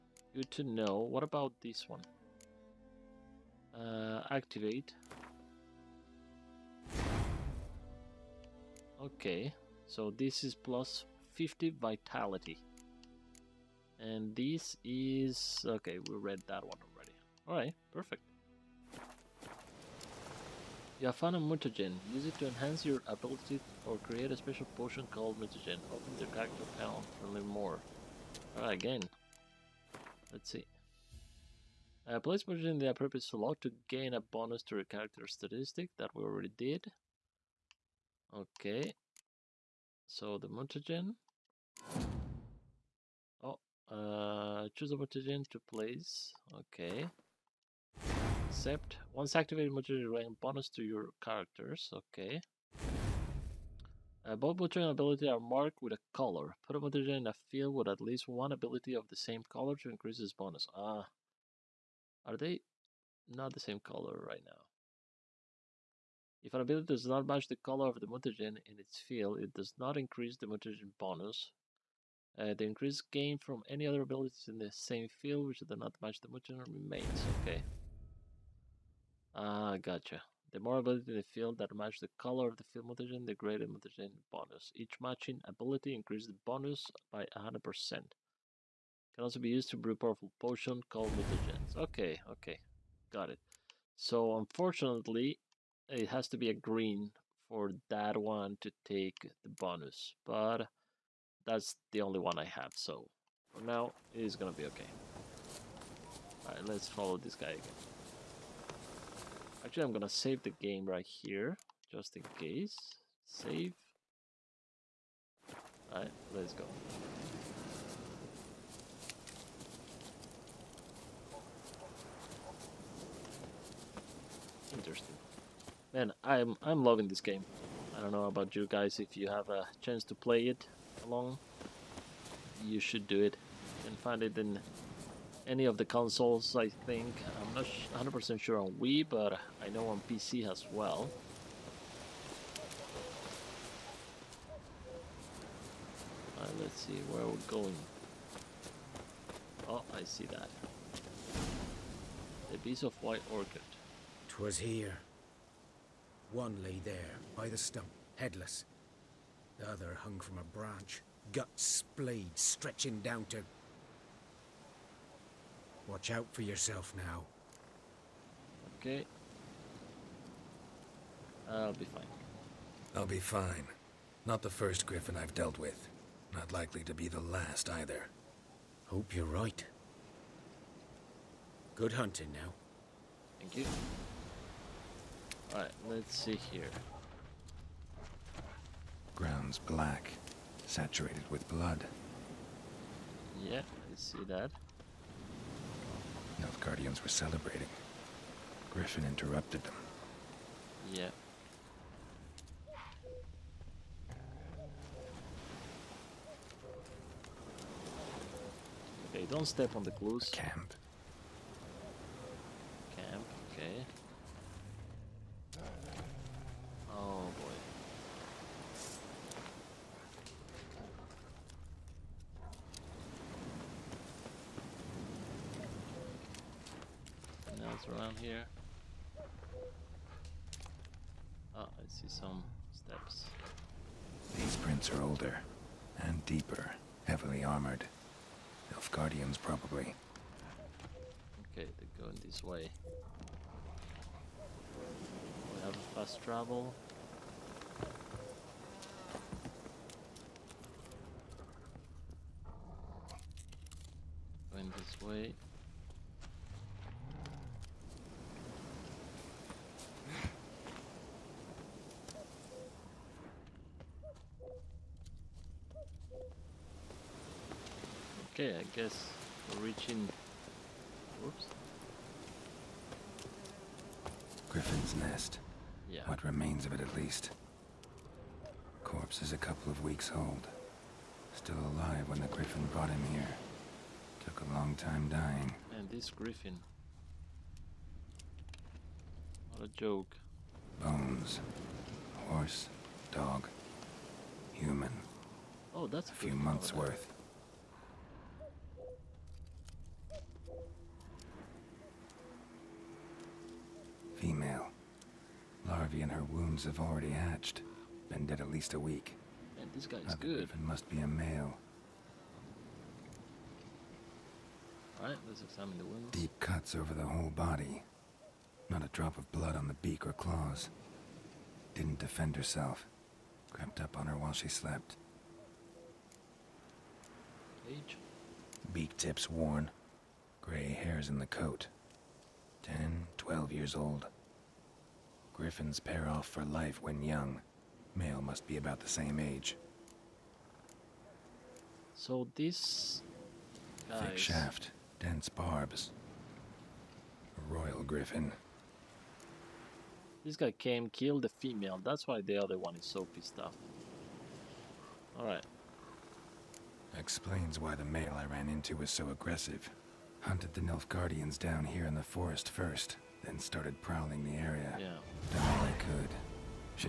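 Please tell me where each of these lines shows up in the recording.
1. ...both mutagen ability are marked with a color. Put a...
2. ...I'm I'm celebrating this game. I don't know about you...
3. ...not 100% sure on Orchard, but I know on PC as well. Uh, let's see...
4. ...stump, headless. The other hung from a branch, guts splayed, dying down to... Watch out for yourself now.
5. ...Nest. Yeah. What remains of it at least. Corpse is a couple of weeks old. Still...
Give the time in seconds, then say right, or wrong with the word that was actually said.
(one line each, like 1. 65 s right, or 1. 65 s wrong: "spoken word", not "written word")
1. 54 s right
2. 126 s wrong: "loving", not "celebrating"
3. 137 s wrong: "Wii", not "Orchard"
4. 157 s wrong: "stretching", not "dying"
5. 274 s right.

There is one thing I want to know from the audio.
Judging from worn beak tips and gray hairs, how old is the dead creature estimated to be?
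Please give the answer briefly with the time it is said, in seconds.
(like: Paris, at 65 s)
10 to 12 years, at 332 s.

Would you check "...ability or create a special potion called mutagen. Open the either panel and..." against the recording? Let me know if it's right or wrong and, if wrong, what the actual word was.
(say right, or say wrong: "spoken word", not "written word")
wrong: "character", not "either".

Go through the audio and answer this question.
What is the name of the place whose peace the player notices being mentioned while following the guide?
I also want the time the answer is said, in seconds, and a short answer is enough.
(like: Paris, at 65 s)
White Orchard, at 153 s.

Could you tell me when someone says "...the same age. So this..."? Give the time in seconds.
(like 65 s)
338 s.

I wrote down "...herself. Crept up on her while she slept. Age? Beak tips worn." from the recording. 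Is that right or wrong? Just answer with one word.
right.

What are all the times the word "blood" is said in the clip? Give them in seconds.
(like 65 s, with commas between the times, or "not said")
191 s, 319 s.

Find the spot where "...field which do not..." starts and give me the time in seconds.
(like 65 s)
75 s.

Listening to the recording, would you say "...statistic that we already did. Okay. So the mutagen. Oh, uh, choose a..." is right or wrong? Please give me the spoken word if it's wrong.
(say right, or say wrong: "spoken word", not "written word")
right.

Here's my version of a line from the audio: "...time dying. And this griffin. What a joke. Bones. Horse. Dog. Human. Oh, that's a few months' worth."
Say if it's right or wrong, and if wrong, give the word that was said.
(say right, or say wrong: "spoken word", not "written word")
right.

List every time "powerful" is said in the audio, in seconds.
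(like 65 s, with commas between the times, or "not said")
89 s.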